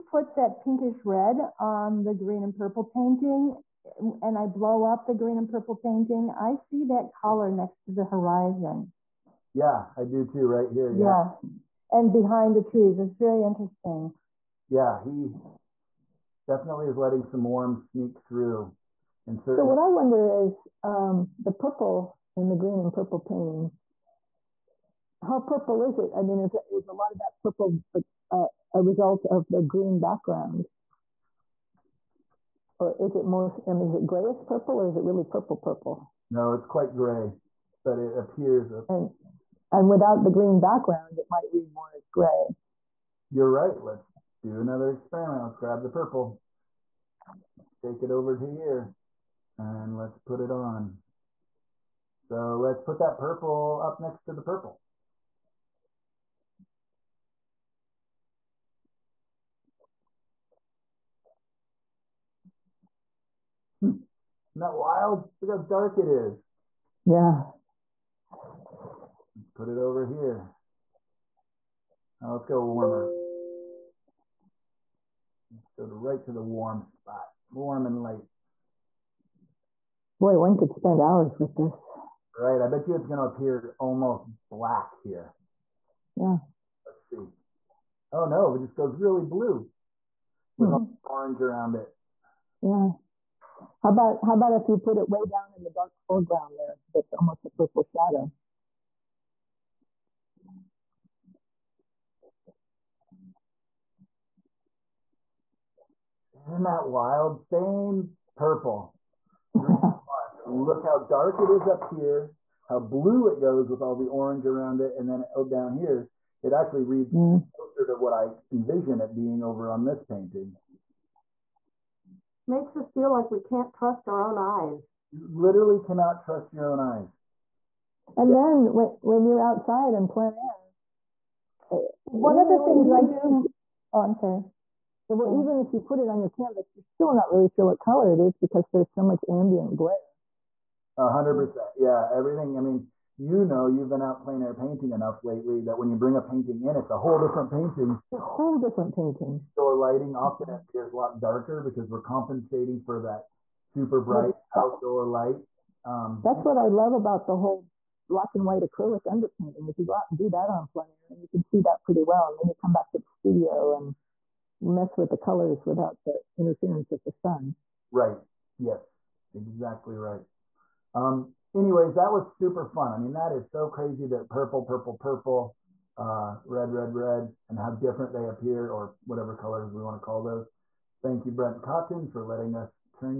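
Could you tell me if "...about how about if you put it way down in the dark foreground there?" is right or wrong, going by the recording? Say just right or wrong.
right.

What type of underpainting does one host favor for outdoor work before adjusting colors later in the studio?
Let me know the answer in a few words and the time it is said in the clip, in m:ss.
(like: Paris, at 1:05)
black and white acrylic, at 2:38.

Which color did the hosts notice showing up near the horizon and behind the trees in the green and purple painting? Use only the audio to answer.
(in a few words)
pinkish red.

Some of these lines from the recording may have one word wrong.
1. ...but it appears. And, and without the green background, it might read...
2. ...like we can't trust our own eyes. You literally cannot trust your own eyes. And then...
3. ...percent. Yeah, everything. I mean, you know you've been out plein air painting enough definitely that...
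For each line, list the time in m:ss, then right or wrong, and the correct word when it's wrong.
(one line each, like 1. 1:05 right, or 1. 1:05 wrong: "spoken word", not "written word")
1. 0:37 right
2. 2:03 right
3. 2:21 wrong: "lately", not "definitely".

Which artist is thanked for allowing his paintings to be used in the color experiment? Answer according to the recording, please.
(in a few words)
Brent Cotton.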